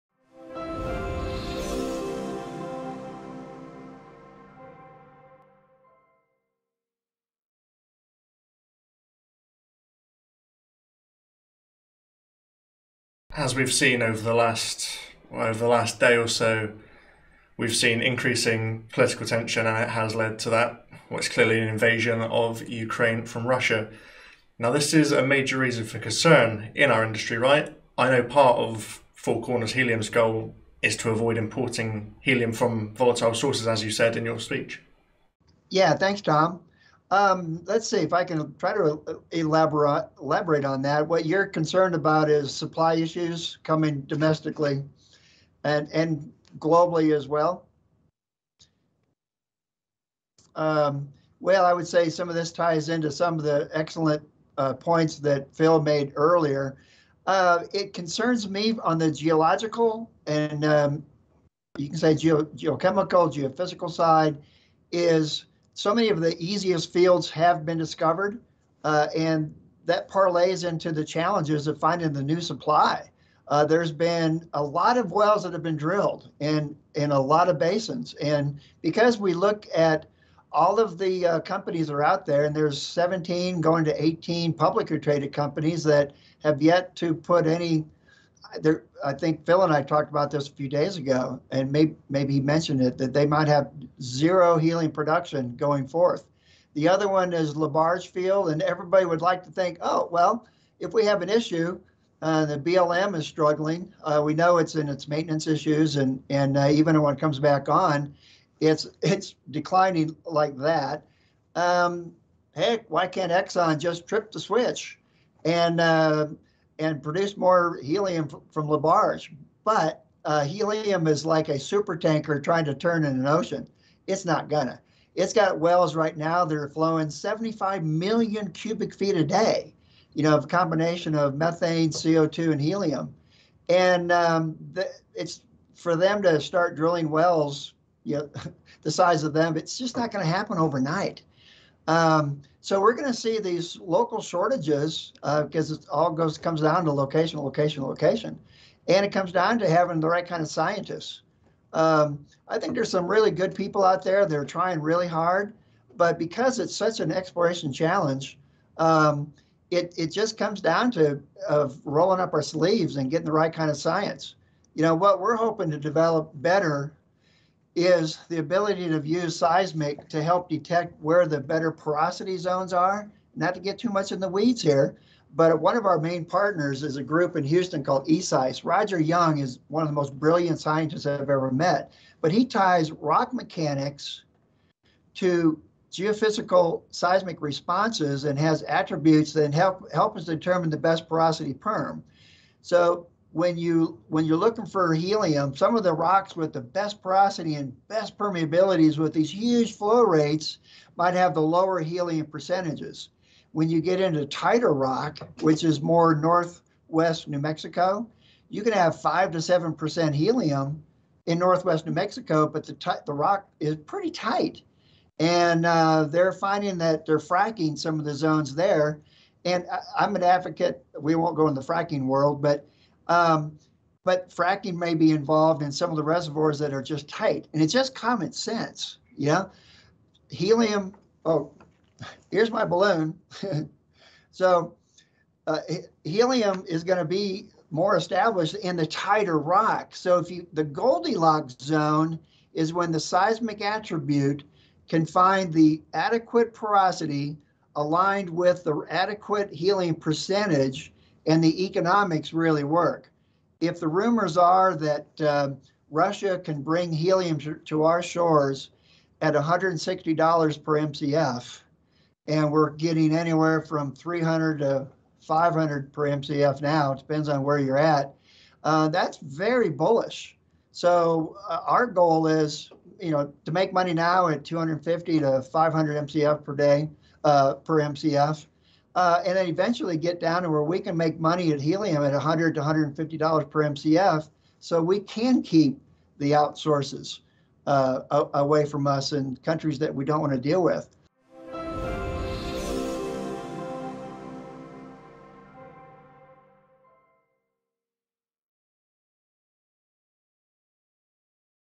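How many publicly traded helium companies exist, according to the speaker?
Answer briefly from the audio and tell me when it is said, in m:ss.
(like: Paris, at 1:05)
18, at 1:24.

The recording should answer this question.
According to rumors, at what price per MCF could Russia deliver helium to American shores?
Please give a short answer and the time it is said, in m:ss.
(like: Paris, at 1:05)
$160, at 4:19.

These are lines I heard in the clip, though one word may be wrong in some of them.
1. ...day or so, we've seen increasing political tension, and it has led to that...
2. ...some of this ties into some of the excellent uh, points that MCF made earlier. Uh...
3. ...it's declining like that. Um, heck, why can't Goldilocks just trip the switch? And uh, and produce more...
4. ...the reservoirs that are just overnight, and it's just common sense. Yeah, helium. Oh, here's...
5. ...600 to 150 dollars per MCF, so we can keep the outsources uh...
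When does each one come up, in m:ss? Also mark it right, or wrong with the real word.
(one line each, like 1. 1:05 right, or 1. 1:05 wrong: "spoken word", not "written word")
1. 0:15 right
2. 0:52 wrong: "Phil", not "MCF"
3. 1:49 wrong: "Exxon", not "Goldilocks"
4. 3:45 wrong: "tight", not "overnight"
5. 4:42 wrong: "100", not "600".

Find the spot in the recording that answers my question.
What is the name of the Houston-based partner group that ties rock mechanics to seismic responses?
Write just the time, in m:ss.
2:58.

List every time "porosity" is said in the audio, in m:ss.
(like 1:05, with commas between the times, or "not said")
2:51, 3:11, 3:17, 4:06.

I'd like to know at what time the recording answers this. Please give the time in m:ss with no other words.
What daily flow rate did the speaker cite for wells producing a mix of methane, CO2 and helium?
2:07.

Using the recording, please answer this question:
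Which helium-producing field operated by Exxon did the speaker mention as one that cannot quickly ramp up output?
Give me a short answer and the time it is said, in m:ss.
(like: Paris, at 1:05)
LaBarge Field, at 1:37.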